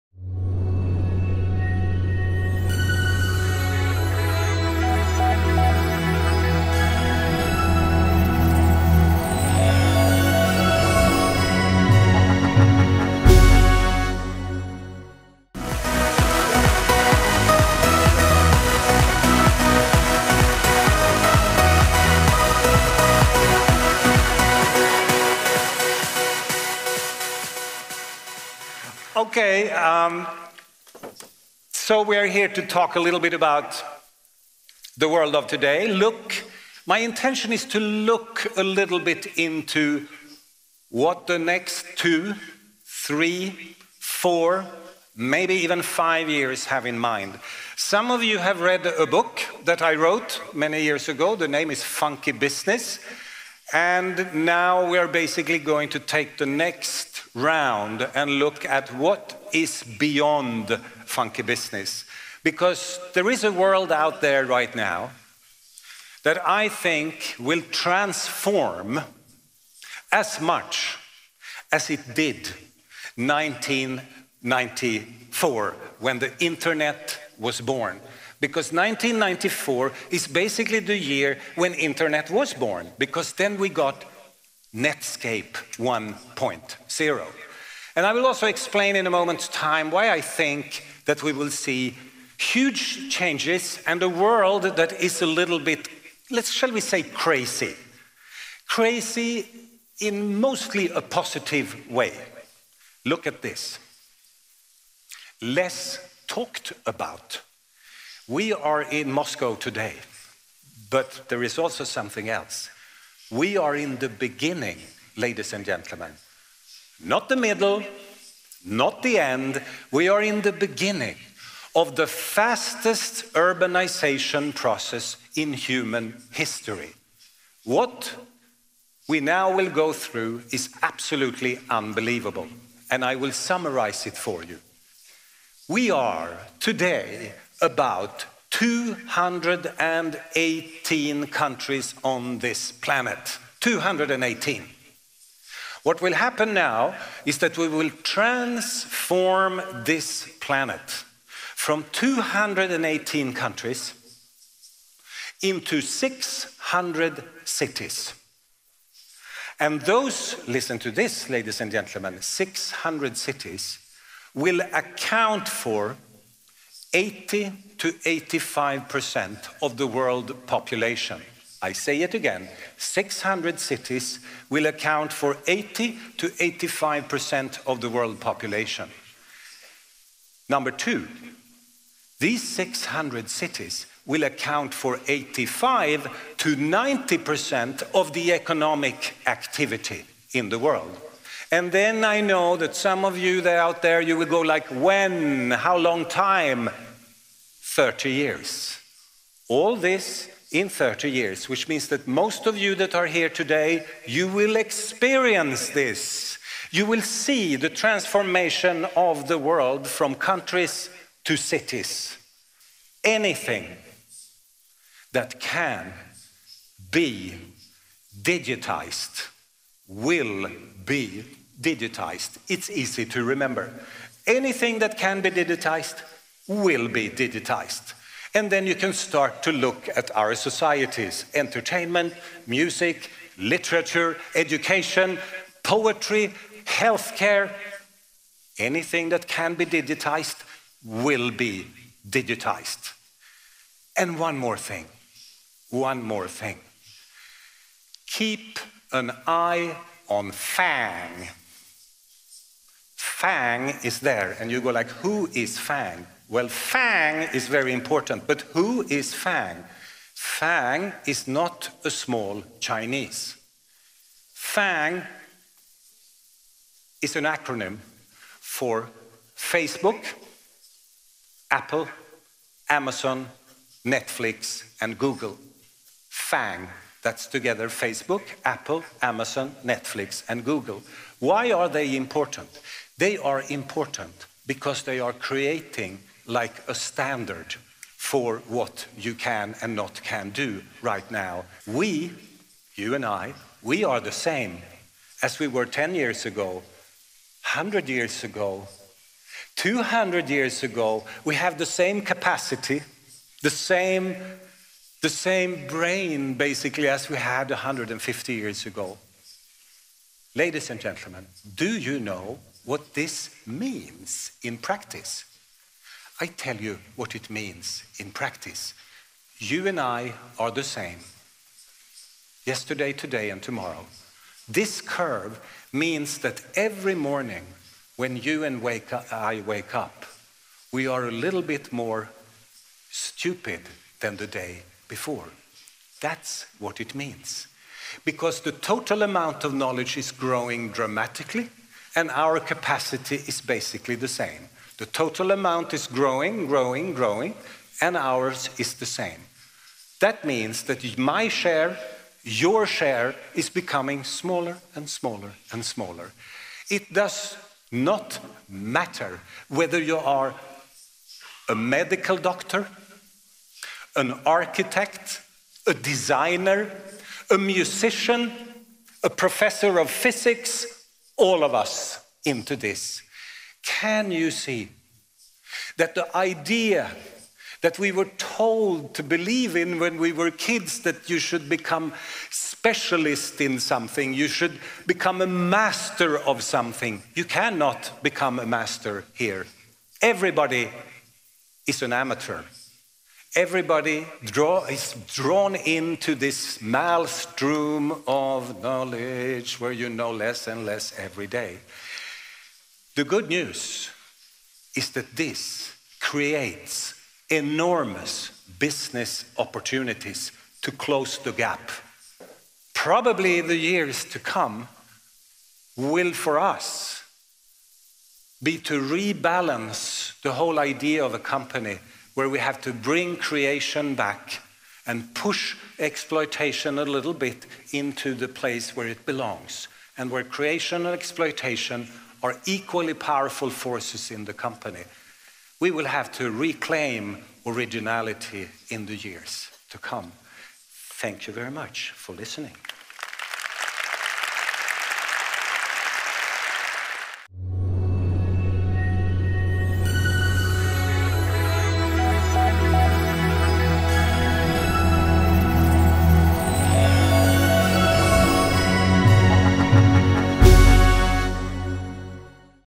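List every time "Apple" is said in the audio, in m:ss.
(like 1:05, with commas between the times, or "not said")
4:31, 4:38.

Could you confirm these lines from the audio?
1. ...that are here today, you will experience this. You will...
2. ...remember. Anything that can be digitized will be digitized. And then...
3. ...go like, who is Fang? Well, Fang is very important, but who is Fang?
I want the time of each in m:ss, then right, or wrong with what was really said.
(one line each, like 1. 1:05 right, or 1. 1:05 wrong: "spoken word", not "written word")
1. 3:22 right
2. 3:43 right
3. 4:14 right.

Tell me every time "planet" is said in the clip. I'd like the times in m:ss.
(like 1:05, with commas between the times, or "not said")
2:22, 2:30.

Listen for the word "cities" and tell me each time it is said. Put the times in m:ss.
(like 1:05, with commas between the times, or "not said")
2:37, 2:43, 2:53, 3:03, 3:31.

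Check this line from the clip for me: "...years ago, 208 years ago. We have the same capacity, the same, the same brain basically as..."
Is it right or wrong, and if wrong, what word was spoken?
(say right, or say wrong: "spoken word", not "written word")
wrong: "200", not "208".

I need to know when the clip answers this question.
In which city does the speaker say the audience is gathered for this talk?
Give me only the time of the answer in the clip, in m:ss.
1:49.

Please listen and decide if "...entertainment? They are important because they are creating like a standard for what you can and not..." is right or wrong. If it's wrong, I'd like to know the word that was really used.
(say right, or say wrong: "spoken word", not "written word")
wrong: "important", not "entertainment".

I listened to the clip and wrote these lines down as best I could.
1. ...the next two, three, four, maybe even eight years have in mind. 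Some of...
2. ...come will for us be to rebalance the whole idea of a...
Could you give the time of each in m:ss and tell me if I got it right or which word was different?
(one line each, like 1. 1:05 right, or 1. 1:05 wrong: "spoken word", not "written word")
1. 0:41 wrong: "five", not "eight"
2. 6:54 right.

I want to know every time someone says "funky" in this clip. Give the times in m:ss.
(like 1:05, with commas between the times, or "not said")
0:51, 1:01.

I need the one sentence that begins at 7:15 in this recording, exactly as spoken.
We will have to reclaim originality in the years to come.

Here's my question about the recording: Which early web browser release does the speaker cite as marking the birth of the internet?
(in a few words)
Netscape 1.0.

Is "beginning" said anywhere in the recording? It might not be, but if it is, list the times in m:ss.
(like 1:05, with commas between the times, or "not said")
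1:54, 2:00.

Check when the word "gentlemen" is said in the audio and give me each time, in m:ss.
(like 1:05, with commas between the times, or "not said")
1:55, 2:41, 5:10.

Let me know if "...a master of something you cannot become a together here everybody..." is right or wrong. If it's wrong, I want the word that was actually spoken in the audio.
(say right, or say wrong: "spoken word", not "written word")
wrong: "master", not "together".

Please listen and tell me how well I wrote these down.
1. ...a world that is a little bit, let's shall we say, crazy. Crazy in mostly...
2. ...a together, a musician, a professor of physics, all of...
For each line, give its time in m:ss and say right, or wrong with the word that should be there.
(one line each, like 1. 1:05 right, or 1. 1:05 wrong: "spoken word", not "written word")
1. 1:34 right
2. 6:05 wrong: "designer", not "together".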